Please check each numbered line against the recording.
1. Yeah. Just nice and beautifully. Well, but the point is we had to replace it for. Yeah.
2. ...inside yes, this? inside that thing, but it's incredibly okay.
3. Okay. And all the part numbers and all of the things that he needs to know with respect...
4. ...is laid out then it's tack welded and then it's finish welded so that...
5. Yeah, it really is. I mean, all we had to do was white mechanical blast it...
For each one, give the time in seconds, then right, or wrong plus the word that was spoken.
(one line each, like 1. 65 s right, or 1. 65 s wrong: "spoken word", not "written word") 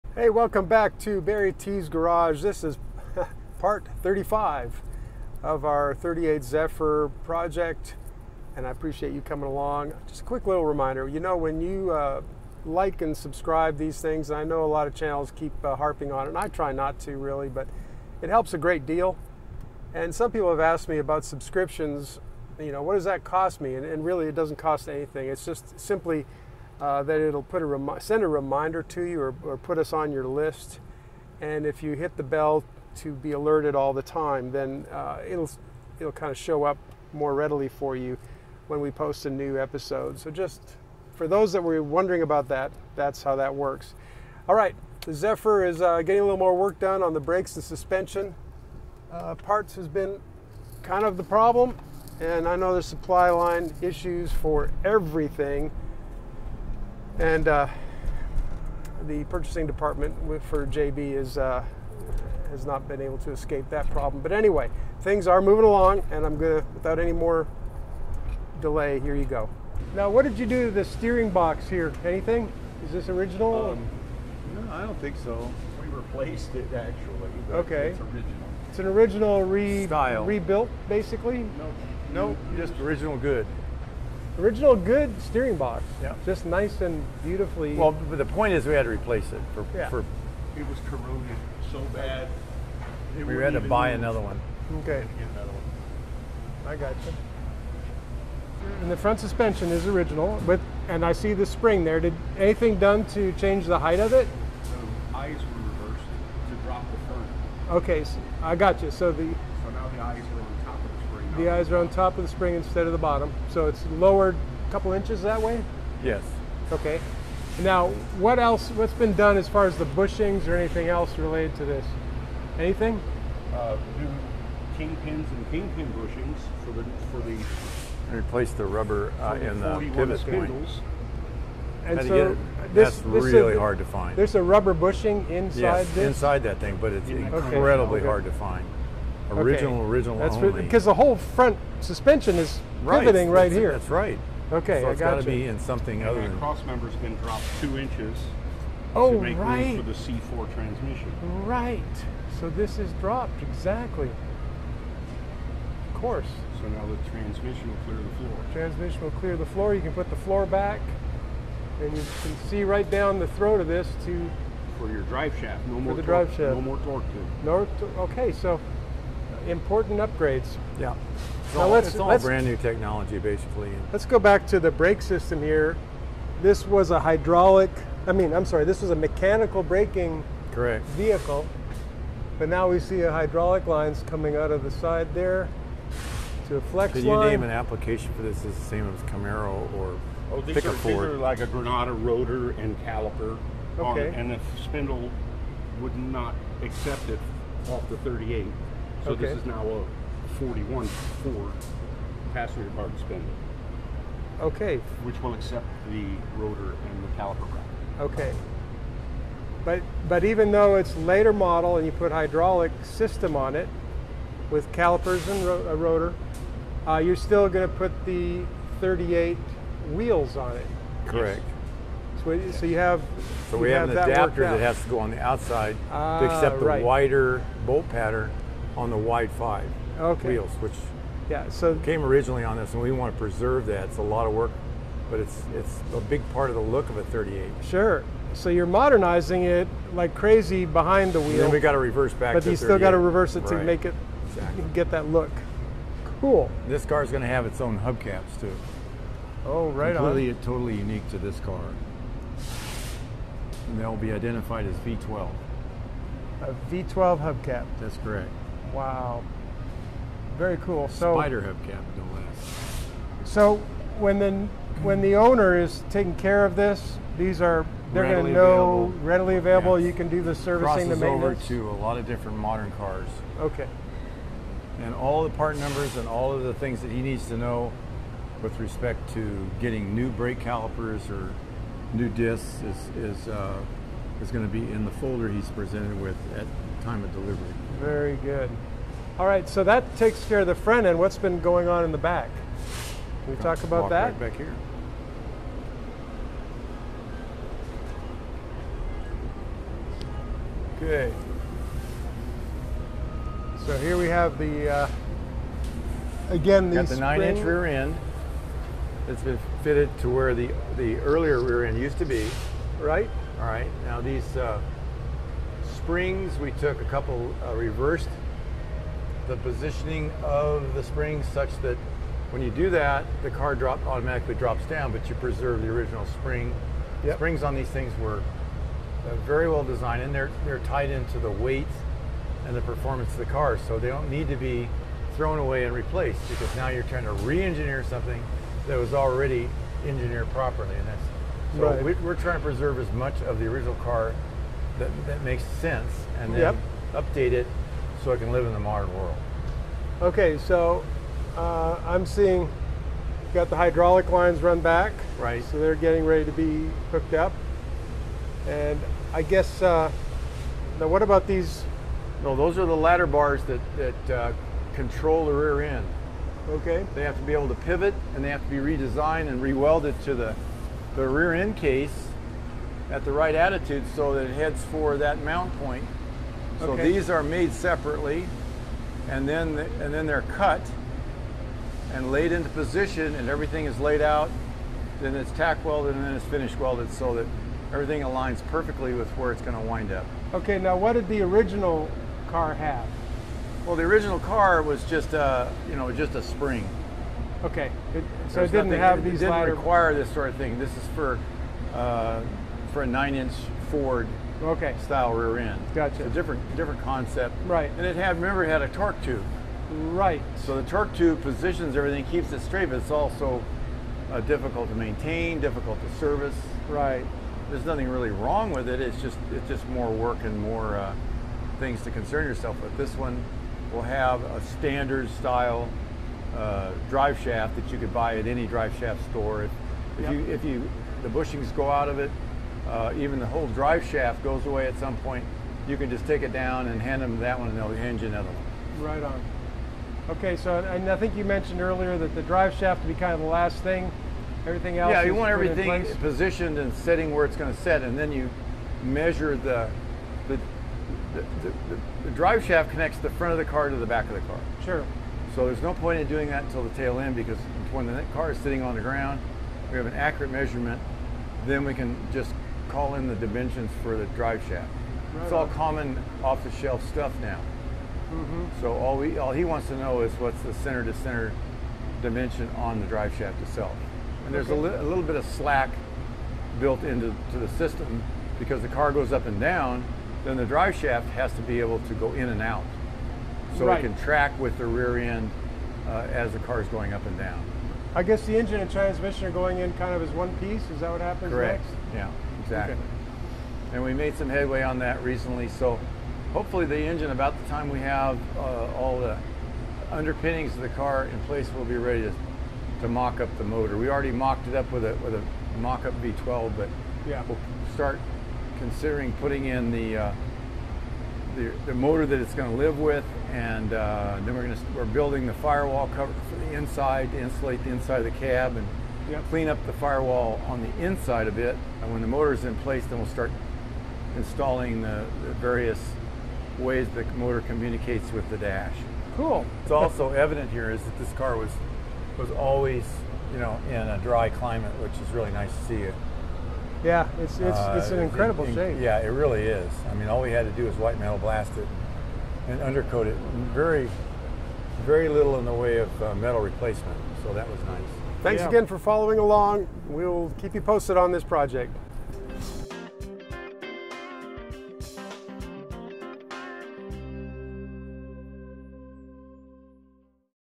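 1. 86 s right
2. 135 s right
3. 273 s right
4. 383 s right
5. 538 s wrong: "metal", not "mechanical".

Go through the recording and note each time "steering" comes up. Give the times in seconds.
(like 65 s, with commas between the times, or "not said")
70 s, 85 s.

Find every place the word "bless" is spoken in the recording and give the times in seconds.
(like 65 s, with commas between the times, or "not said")
not said.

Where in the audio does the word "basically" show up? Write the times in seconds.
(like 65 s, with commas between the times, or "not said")
80 s, 173 s.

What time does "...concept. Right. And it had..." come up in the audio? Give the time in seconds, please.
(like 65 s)
406 s.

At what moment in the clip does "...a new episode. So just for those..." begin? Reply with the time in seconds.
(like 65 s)
39 s.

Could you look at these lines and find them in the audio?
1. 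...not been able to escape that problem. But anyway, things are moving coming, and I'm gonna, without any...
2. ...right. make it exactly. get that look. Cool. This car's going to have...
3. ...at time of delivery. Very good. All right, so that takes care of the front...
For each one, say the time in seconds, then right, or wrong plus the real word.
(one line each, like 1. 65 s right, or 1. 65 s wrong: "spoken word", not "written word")
1. 62 s wrong: "along", not "coming"
2. 243 s right
3. 286 s right.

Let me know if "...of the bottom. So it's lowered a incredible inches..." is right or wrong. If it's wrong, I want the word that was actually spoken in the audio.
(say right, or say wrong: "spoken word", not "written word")
wrong: "couple", not "incredible".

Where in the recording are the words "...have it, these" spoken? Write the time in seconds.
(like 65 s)
398 s.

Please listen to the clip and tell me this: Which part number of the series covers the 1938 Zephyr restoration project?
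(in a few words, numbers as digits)
35.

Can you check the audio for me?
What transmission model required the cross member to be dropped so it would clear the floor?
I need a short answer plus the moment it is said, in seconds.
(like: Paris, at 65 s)
C4, at 149 s.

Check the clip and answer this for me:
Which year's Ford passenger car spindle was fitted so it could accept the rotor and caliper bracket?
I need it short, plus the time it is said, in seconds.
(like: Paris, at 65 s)
1941, at 200 s.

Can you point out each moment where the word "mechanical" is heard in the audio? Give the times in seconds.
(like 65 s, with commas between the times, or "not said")
178 s.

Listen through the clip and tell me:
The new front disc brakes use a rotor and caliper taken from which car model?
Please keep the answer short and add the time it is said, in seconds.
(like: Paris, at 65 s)
Granada, at 191 s.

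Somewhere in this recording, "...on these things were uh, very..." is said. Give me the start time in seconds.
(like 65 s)
327 s.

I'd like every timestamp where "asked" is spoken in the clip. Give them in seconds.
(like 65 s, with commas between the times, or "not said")
20 s.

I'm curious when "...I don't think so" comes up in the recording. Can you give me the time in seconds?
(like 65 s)
74 s.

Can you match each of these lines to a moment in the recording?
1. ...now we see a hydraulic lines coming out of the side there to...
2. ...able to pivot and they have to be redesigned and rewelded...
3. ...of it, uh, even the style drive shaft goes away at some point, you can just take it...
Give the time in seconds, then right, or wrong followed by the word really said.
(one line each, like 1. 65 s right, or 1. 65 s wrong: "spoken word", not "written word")
1. 182 s right
2. 367 s right
3. 431 s wrong: "whole", not "style".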